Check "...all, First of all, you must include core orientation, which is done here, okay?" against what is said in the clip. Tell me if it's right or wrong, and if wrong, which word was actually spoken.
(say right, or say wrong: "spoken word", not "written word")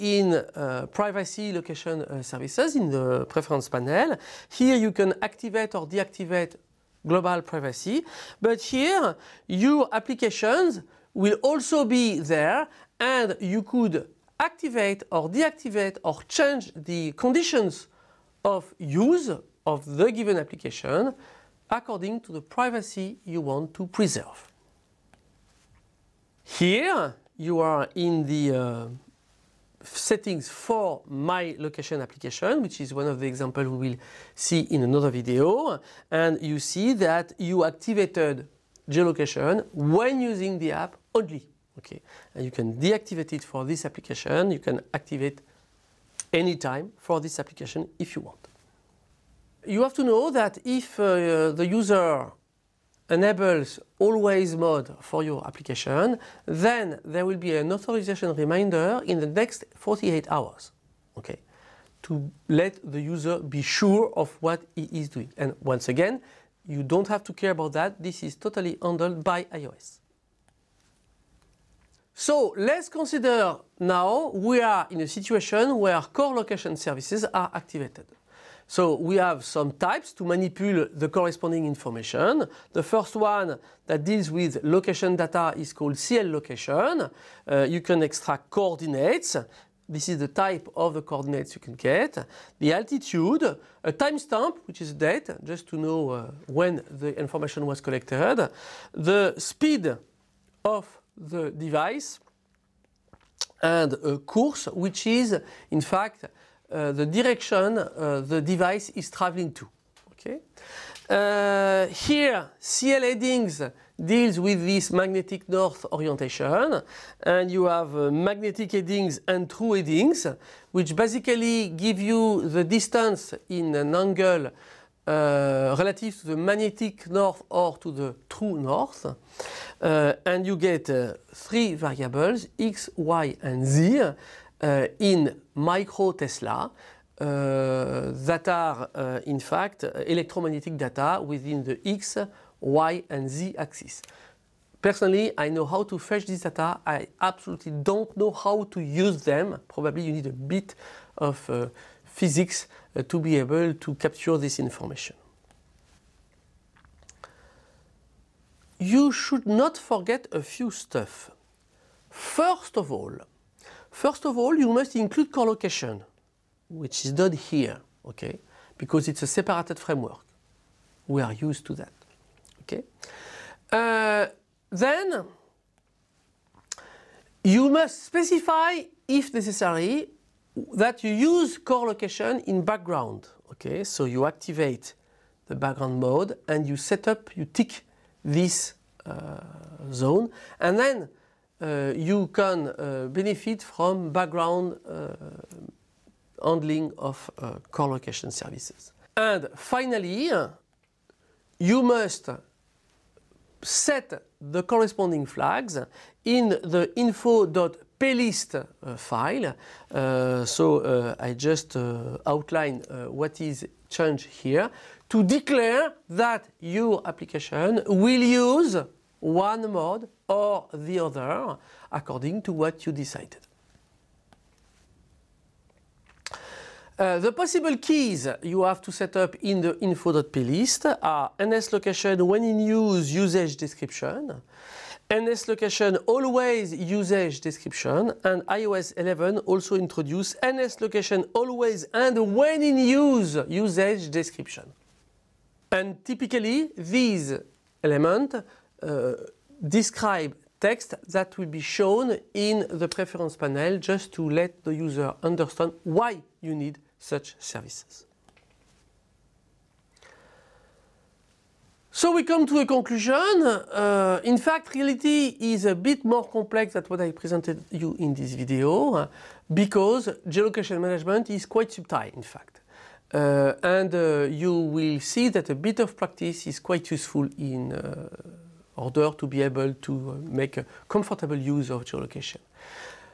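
wrong: "location", not "orientation".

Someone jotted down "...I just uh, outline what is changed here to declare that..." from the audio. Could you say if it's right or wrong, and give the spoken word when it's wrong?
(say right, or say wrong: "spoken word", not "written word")
right.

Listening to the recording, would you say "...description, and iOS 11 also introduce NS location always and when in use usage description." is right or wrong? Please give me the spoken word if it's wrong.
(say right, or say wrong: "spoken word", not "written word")
right.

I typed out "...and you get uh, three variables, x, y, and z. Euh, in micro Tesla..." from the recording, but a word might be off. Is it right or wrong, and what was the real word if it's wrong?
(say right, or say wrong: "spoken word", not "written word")
right.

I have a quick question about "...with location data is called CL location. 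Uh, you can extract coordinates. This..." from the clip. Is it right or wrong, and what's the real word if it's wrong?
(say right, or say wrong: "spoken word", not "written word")
right.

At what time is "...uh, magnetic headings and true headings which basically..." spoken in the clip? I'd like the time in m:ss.
1:57.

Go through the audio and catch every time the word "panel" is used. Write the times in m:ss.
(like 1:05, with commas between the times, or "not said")
0:03, 4:13.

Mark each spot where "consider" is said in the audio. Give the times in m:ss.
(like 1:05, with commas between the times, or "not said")
1:12.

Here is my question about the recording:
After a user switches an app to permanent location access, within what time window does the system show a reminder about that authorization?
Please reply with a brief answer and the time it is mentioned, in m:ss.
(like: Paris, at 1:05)
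48 hours, at 0:59.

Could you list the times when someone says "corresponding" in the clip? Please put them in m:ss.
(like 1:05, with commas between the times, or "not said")
1:21, 3:24.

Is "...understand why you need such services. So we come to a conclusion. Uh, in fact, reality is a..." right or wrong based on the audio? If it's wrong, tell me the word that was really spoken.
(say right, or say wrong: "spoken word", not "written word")
right.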